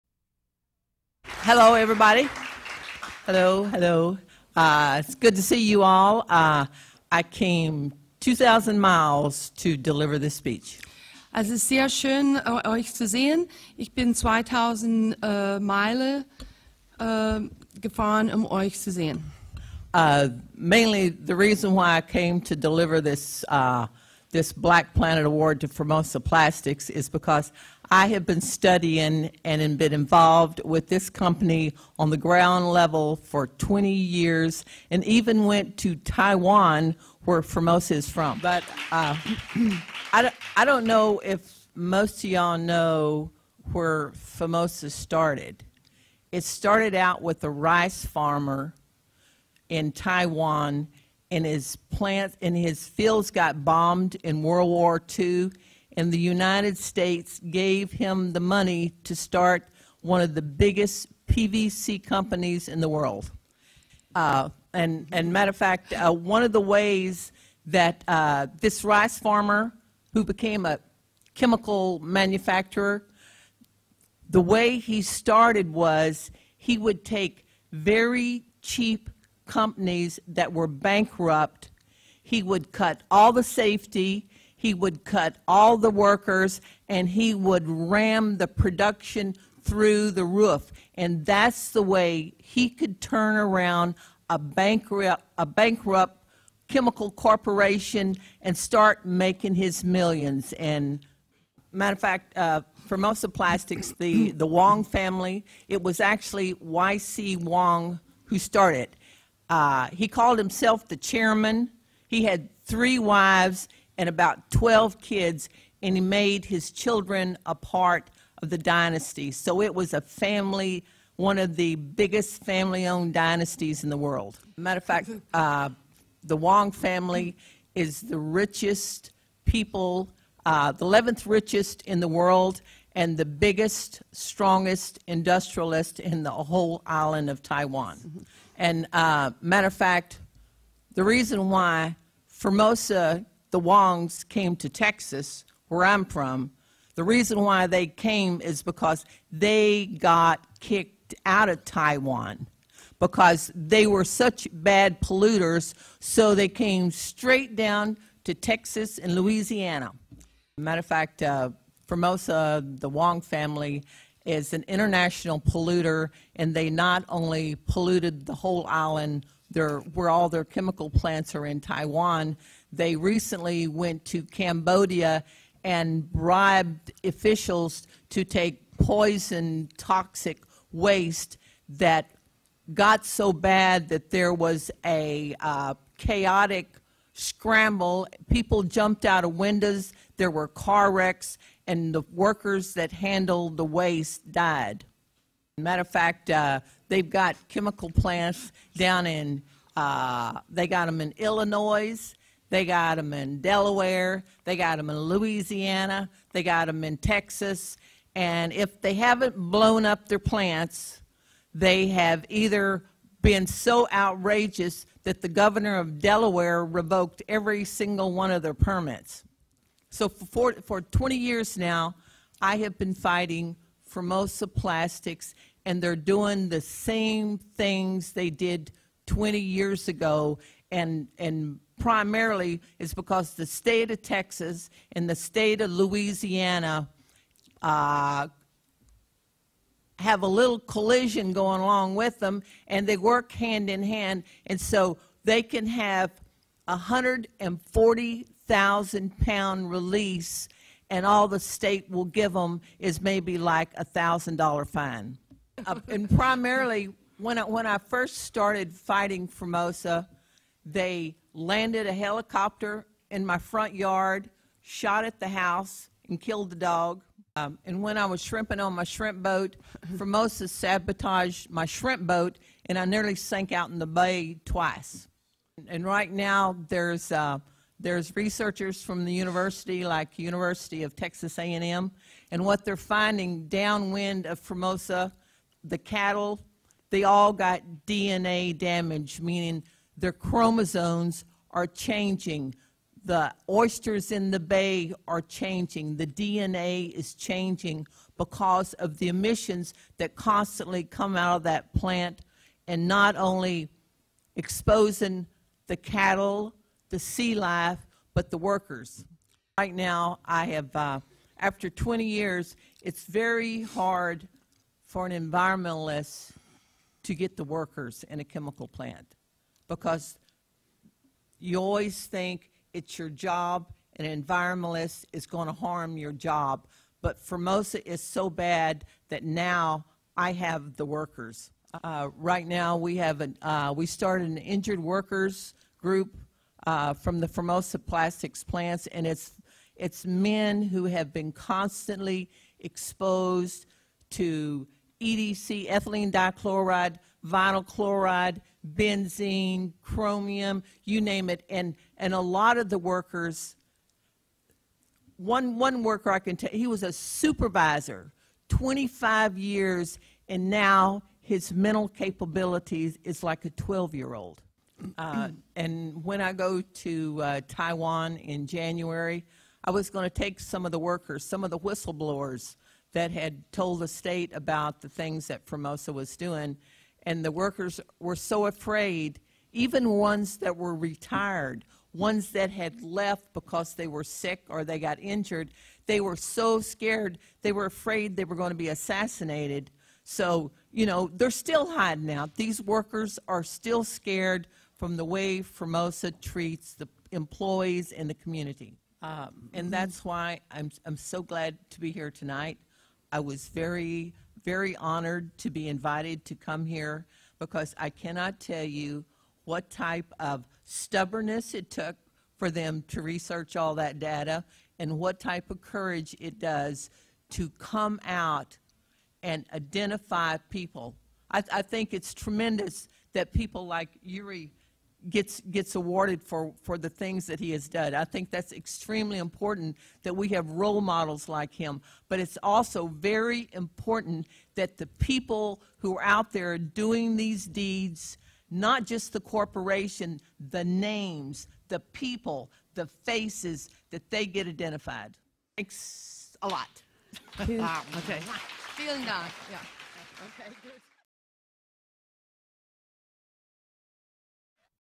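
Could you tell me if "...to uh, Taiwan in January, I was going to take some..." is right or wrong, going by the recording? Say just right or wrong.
right.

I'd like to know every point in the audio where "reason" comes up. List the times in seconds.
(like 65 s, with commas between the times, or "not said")
21 s, 141 s, 147 s.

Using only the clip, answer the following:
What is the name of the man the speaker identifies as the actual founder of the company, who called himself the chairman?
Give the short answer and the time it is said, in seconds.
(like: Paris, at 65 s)
Y.C. Wang, at 106 s.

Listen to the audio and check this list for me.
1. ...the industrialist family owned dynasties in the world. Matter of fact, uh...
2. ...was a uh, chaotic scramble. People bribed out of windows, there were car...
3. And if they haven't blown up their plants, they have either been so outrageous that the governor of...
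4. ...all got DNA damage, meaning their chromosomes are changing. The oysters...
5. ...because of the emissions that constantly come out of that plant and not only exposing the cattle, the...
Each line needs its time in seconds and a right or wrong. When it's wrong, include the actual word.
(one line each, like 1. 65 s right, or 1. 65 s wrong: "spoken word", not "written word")
1. 121 s wrong: "biggest", not "industrialist"
2. 184 s wrong: "jumped", not "bribed"
3. 208 s right
4. 287 s right
5. 298 s right.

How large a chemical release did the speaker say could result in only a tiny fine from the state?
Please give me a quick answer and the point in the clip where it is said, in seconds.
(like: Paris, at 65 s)
140,000 pounds, at 246 s.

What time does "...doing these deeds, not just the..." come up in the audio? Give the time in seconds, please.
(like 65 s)
436 s.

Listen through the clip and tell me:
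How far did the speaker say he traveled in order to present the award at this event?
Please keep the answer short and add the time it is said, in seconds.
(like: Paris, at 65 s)
2000 miles, at 8 s.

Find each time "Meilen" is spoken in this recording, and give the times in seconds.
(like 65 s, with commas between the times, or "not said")
15 s.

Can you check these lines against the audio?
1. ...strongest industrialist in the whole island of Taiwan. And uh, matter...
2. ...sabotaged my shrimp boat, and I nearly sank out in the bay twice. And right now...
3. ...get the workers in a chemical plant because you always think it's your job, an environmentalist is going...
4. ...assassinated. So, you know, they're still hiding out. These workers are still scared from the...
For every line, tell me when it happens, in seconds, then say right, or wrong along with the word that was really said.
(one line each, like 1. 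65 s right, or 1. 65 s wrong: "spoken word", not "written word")
1. 134 s right
2. 270 s right
3. 317 s right
4. 388 s right.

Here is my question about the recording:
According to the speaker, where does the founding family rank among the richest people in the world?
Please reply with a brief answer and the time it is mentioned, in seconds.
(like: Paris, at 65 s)
11th, at 130 s.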